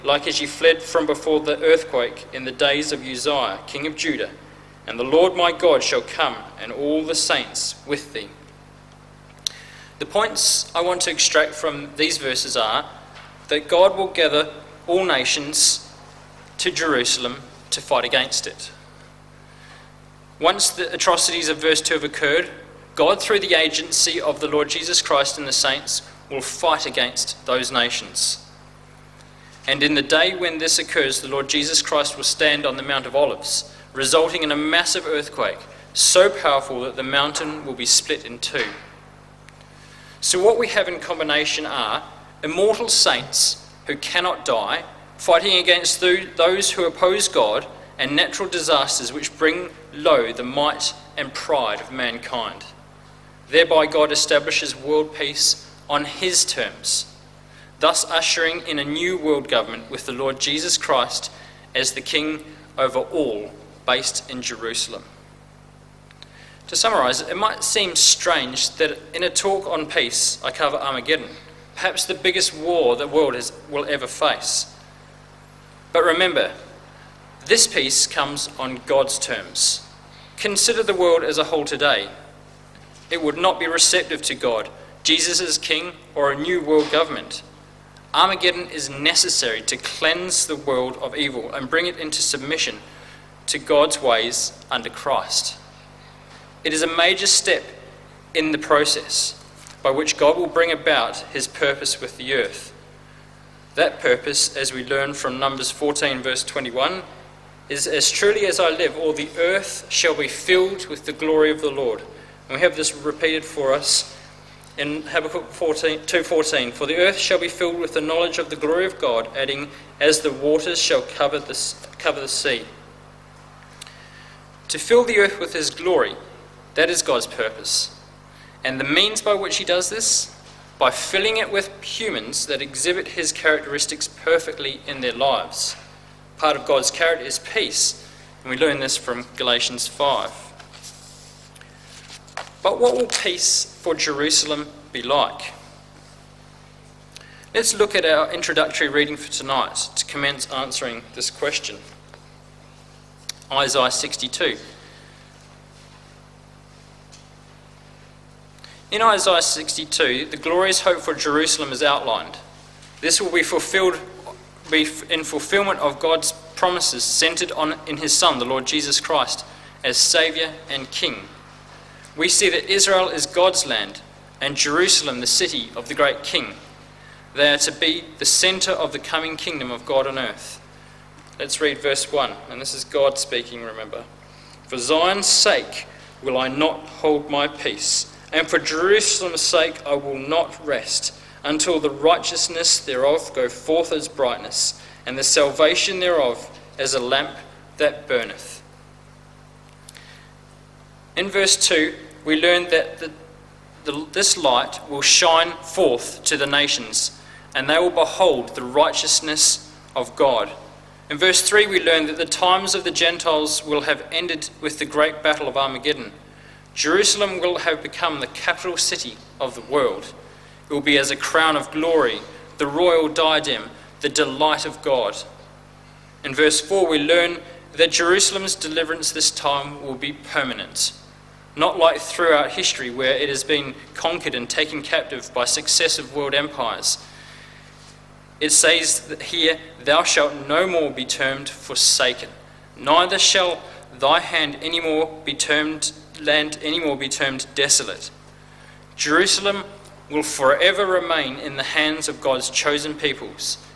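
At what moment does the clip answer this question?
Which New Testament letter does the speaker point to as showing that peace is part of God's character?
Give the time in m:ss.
2:19.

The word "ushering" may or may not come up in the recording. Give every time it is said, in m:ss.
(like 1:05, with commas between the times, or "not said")
0:58.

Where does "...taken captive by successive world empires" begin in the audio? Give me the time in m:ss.
3:54.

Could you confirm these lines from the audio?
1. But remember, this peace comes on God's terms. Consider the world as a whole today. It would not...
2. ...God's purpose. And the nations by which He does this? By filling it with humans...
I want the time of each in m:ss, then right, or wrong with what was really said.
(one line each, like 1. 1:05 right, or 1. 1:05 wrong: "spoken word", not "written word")
1. 1:15 right
2. 2:07 wrong: "means", not "nations".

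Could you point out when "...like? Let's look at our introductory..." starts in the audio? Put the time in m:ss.
2:25.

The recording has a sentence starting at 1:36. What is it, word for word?
It is a major step in the process by which God will bring about his purpose with the earth.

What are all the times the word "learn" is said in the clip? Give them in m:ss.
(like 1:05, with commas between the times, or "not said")
1:44, 2:18, 3:22, 3:31, 3:46.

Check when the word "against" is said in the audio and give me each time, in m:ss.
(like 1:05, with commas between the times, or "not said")
0:18, 0:26, 0:45.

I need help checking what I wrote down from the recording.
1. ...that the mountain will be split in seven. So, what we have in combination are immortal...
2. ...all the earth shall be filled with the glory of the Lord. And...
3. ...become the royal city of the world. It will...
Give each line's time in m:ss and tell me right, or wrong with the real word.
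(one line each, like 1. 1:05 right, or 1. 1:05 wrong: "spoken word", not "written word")
1. 0:36 wrong: "two", not "seven"
2. 1:48 right
3. 3:37 wrong: "capital", not "royal".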